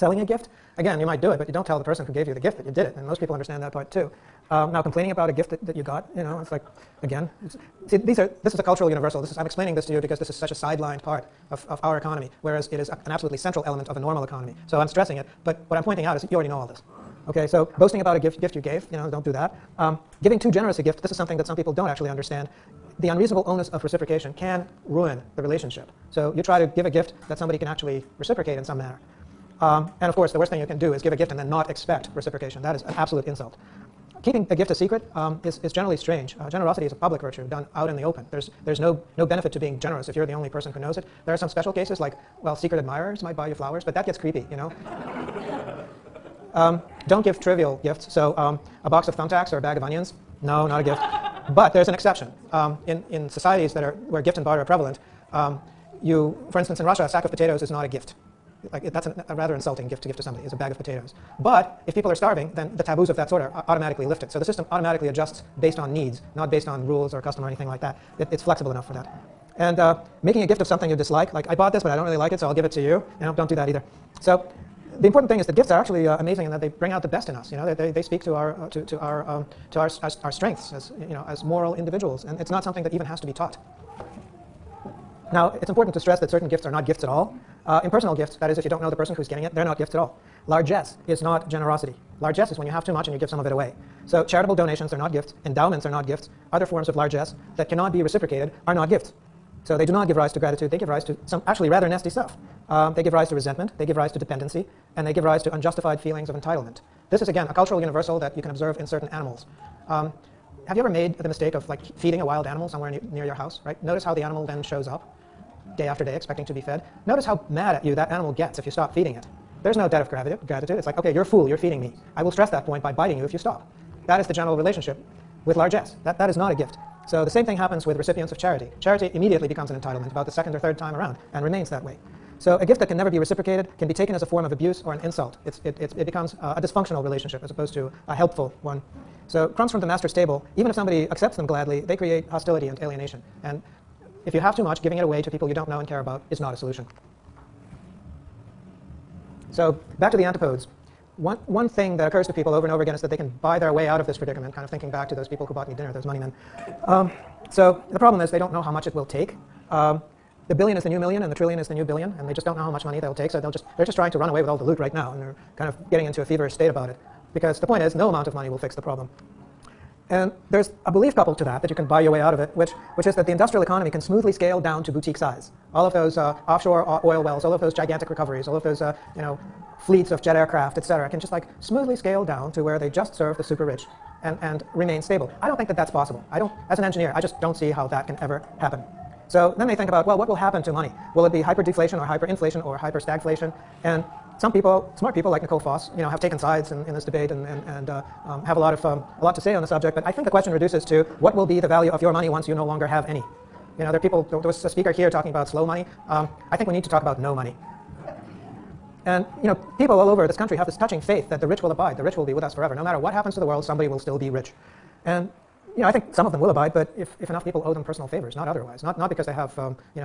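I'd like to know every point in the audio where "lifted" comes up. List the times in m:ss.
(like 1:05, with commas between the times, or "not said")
1:04.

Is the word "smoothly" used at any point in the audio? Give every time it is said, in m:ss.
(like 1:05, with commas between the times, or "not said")
2:54, 3:01.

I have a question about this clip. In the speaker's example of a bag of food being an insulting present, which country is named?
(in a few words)
Russia.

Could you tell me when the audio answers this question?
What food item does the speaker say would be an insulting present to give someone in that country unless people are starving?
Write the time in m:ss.
0:57.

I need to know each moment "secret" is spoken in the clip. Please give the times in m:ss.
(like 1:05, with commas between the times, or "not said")
0:34, 0:42.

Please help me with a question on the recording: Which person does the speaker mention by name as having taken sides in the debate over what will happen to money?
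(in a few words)
Nicole Foss.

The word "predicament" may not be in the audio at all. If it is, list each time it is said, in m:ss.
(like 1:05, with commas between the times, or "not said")
2:34.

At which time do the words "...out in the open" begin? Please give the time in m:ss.
0:37.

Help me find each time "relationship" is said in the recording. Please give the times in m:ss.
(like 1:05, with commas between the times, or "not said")
0:25, 2:04, 2:17.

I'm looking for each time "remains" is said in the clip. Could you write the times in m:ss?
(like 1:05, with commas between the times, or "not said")
2:11, 3:04.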